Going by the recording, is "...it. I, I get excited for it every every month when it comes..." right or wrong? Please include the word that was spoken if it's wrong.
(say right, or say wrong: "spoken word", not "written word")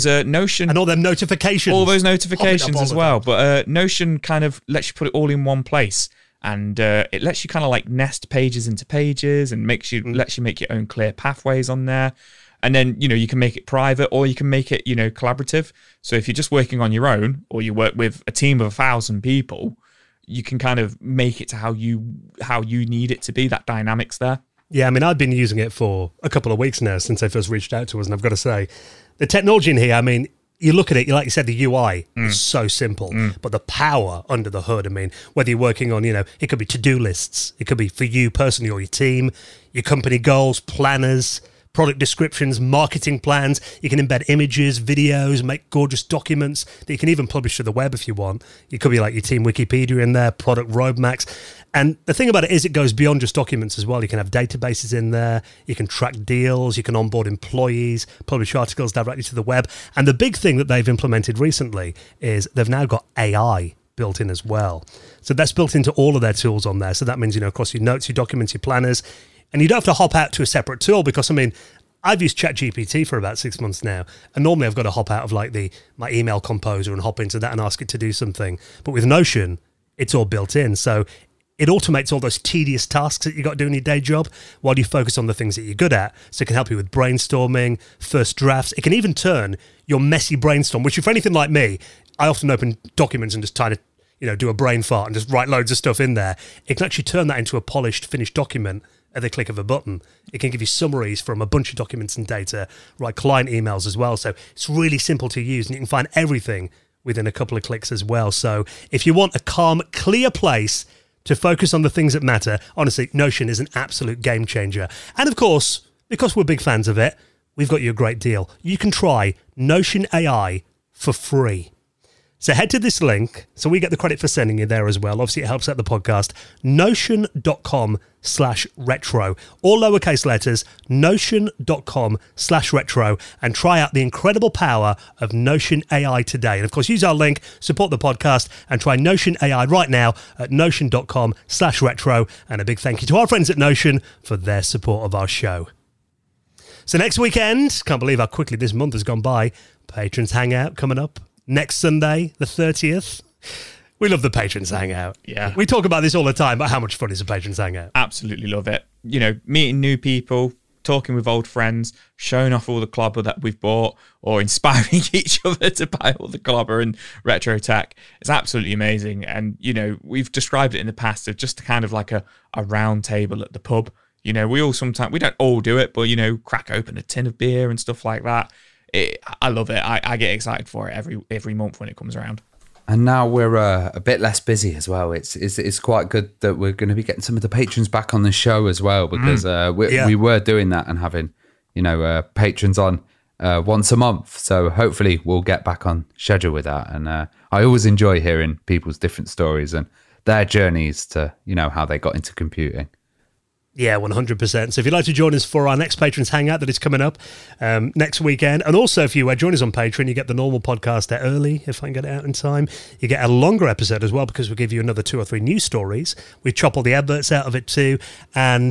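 right.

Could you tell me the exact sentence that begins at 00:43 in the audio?
You can embed images, videos, make gorgeous documents that you can even publish to the web if you want.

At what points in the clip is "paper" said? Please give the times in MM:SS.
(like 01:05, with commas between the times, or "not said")
not said.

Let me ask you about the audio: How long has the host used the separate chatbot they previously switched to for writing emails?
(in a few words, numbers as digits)
About 6 months.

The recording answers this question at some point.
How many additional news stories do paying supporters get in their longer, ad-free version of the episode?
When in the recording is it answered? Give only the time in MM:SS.
03:35.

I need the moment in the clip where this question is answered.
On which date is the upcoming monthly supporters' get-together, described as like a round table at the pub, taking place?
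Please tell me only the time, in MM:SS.
02:31.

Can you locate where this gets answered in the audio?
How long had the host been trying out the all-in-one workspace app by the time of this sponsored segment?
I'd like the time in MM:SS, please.
00:26.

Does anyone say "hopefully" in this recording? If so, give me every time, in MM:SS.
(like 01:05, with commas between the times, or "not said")
03:14.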